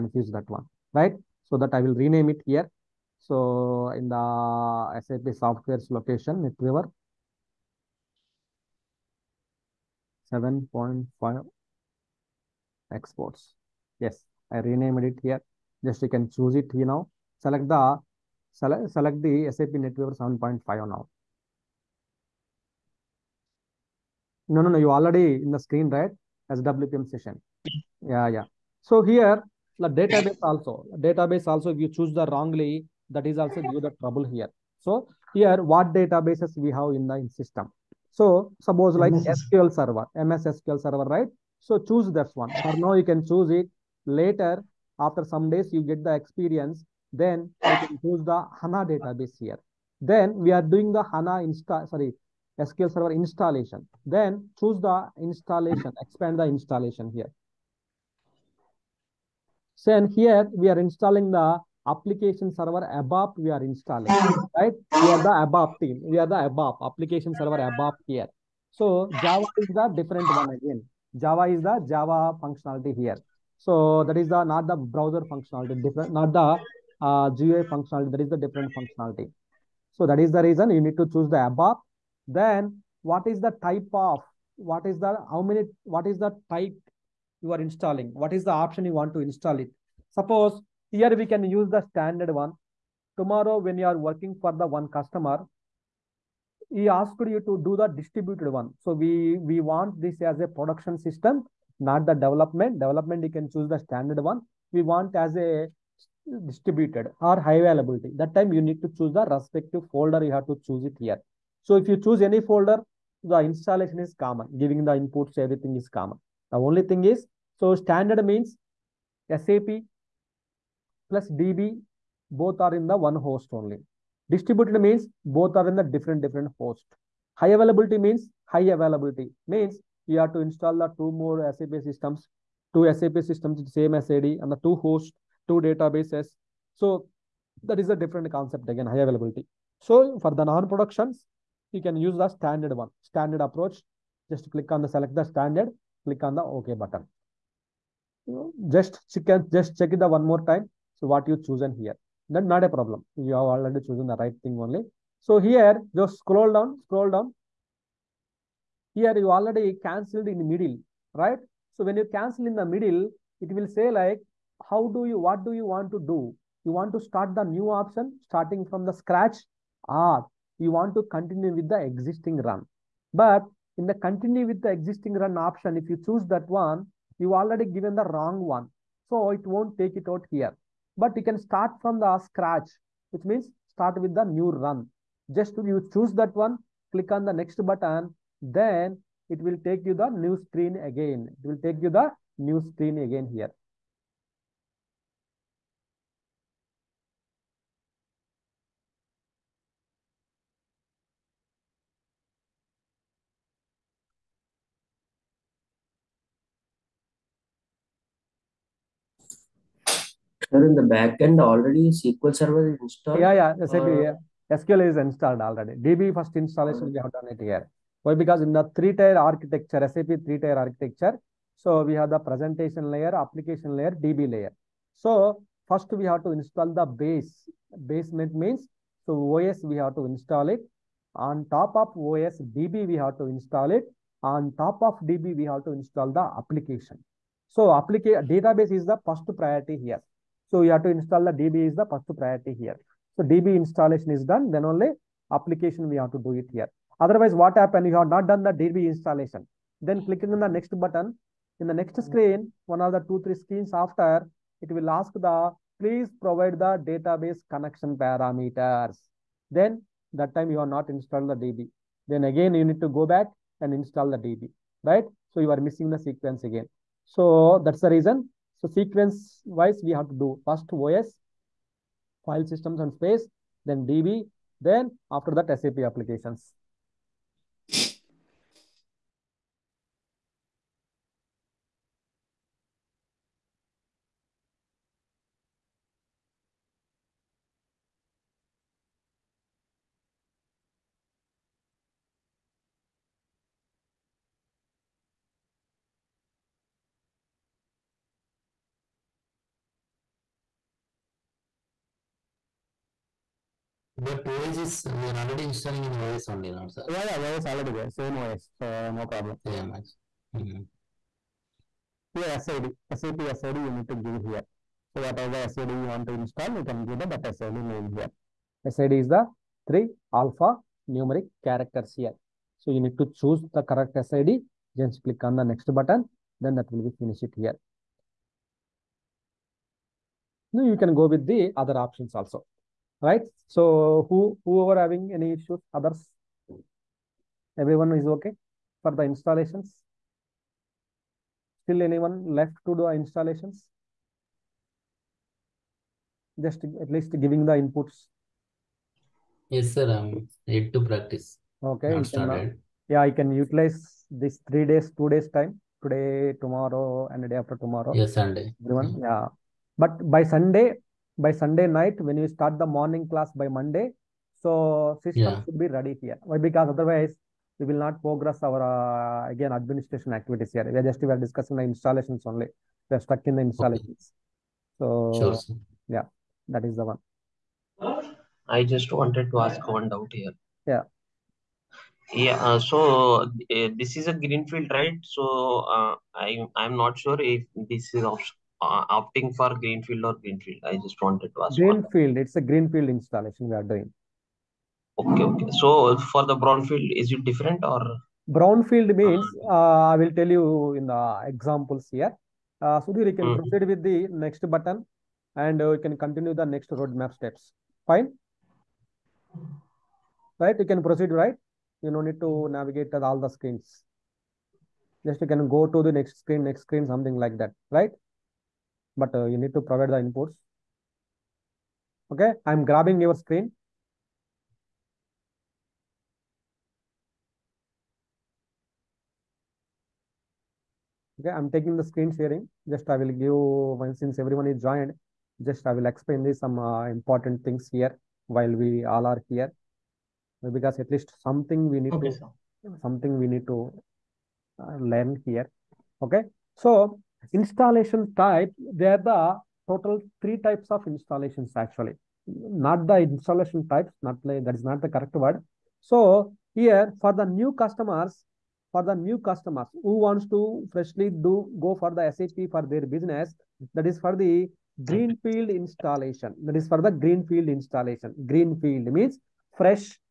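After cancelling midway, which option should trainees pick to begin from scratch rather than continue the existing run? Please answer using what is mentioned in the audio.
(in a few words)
new run.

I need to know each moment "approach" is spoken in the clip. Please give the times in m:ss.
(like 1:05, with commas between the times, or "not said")
2:23.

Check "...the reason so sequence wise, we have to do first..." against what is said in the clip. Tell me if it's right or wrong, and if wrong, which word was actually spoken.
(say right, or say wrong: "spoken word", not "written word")
right.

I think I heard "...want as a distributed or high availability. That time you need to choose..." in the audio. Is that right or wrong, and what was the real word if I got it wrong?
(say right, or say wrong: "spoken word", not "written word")
right.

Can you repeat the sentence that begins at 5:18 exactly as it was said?
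SID is the three alpha numeric characters here.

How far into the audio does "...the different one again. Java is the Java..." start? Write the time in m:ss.
1:09.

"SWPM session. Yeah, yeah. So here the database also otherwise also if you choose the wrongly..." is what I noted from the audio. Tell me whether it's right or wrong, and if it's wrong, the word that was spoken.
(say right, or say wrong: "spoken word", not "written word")
wrong: "database", not "otherwise".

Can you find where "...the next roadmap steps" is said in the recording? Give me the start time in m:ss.
6:46.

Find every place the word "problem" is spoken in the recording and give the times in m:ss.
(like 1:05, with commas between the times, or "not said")
2:32, 5:09.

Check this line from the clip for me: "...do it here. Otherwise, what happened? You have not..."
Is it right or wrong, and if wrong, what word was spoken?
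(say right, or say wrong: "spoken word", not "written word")
right.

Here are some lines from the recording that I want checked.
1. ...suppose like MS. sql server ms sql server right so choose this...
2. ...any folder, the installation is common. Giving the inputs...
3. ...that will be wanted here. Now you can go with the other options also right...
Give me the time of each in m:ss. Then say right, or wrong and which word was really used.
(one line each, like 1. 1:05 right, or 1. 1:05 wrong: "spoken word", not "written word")
1. 0:38 right
2. 1:52 right
3. 5:26 wrong: "finished", not "wanted".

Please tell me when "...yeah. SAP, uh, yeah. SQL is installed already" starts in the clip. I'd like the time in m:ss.
3:33.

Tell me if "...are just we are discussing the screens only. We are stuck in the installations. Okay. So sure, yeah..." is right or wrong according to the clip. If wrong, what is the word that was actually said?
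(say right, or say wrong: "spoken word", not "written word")
wrong: "installations", not "screens".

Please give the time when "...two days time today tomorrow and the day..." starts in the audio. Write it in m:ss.
5:54.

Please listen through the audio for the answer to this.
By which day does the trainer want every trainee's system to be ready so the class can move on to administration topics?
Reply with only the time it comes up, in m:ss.
6:03.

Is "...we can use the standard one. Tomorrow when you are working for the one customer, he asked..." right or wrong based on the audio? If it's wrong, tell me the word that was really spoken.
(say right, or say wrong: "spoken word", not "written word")
right.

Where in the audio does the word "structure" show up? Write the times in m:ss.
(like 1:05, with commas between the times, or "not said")
3:30.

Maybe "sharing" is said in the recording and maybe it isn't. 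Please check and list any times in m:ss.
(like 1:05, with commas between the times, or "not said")
7:12.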